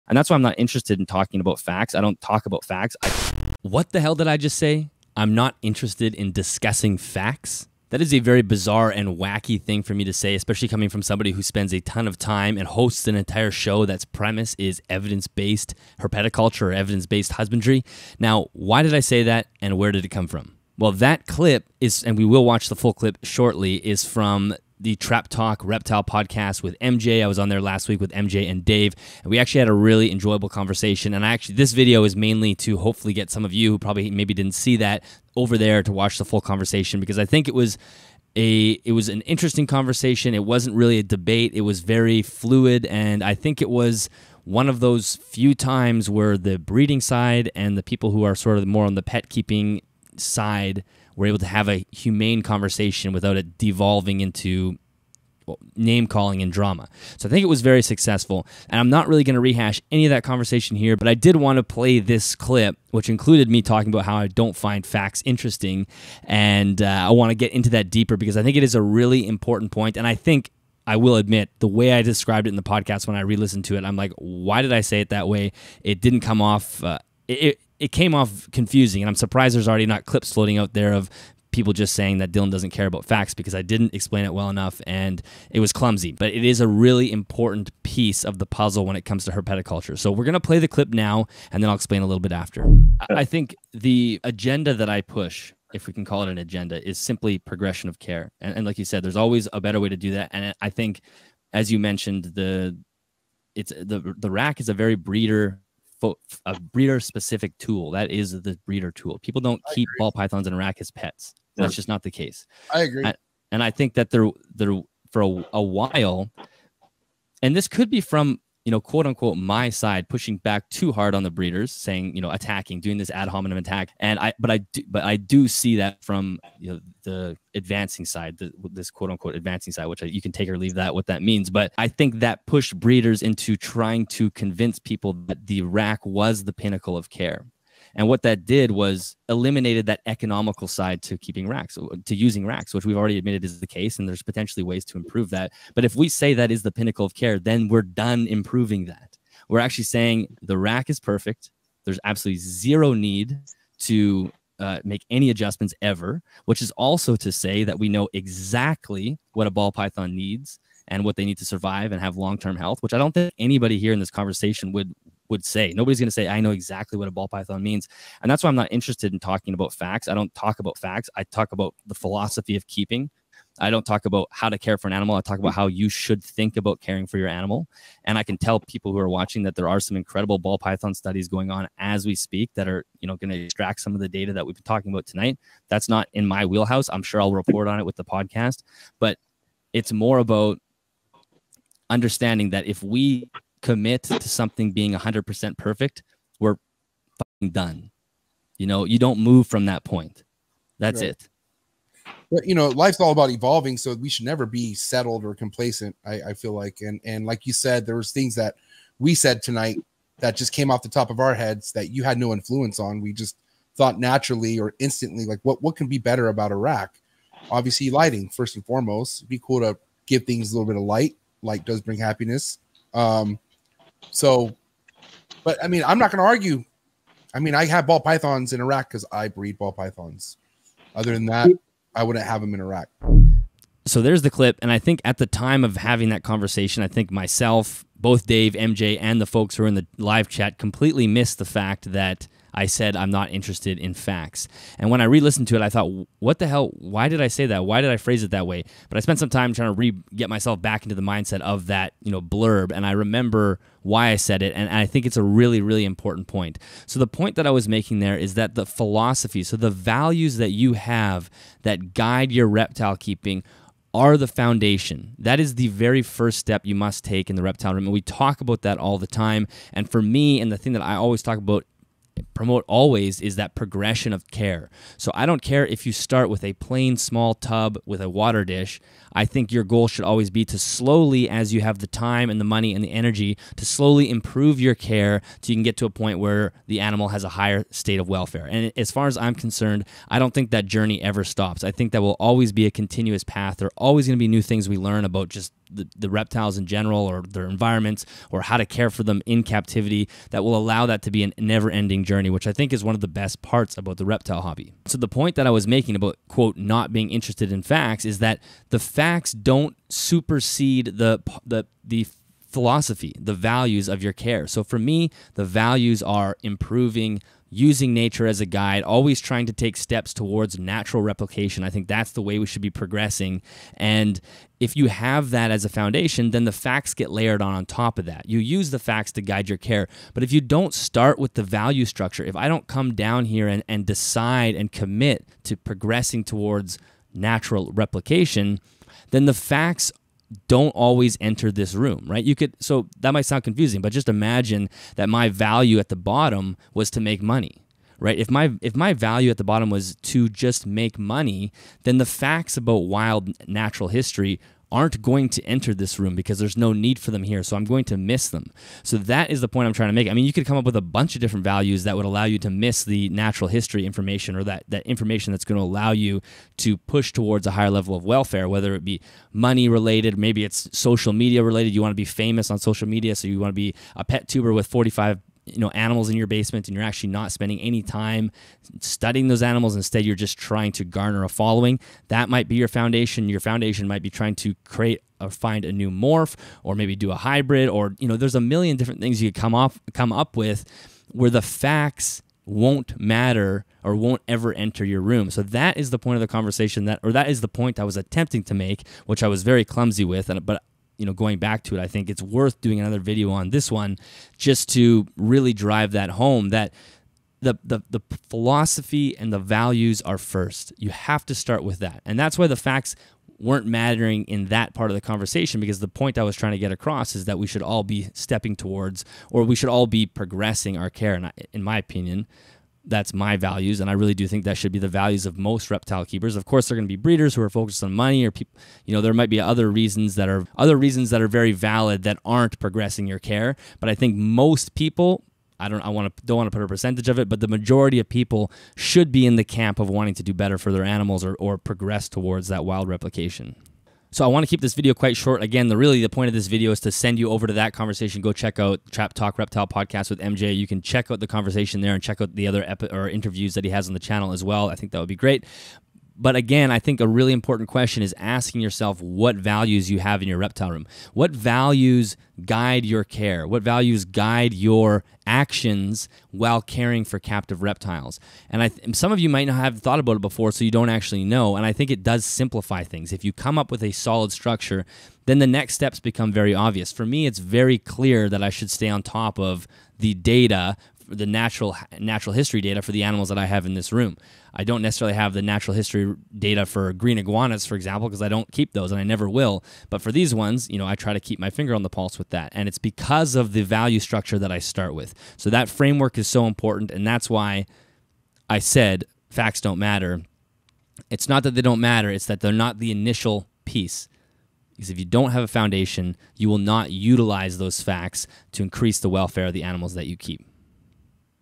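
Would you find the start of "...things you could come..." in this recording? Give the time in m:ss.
6:29.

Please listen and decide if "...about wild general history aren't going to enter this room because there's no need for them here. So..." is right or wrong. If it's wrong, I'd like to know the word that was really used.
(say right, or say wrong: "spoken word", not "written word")
wrong: "natural", not "general".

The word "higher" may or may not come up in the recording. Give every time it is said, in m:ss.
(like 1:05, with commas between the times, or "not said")
4:47, 6:07.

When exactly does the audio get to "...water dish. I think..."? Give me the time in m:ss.
4:38.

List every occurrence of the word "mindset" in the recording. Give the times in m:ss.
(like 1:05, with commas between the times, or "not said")
4:11.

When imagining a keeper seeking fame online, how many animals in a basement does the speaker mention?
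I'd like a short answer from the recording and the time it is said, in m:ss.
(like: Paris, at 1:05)
45, at 6:14.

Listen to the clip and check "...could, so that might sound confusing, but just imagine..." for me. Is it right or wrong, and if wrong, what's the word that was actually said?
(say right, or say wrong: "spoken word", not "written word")
right.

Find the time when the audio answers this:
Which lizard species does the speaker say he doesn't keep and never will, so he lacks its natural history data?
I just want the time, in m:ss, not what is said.
8:06.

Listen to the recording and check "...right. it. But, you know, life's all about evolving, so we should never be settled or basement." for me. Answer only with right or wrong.
wrong.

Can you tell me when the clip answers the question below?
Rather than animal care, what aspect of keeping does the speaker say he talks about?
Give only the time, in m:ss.
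2:51.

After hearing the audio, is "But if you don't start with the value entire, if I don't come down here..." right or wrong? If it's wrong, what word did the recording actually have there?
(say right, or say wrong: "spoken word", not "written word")
wrong: "structure", not "entire".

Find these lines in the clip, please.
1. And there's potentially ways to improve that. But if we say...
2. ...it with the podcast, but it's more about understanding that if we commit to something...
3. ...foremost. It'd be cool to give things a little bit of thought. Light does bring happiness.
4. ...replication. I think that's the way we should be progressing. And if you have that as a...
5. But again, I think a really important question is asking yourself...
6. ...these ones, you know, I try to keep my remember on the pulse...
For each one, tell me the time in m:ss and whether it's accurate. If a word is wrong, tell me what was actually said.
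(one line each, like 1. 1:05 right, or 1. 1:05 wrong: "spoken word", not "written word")
1. 2:23 right
2. 3:07 right
3. 3:38 wrong: "light", not "thought"
4. 5:21 right
5. 7:36 right
6. 8:10 wrong: "finger", not "remember".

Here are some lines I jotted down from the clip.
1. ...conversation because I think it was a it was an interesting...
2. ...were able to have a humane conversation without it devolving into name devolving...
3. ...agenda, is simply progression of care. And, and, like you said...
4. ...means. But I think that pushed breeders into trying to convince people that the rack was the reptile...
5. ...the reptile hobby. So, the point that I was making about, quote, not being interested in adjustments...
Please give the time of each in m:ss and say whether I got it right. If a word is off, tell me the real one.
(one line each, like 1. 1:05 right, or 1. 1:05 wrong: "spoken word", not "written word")
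1. 0:36 right
2. 0:51 wrong: "calling", not "devolving"
3. 1:36 right
4. 2:11 wrong: "pinnacle", not "reptile"
5. 5:03 wrong: "facts", not "adjustments".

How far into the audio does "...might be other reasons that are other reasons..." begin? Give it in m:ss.
7:09.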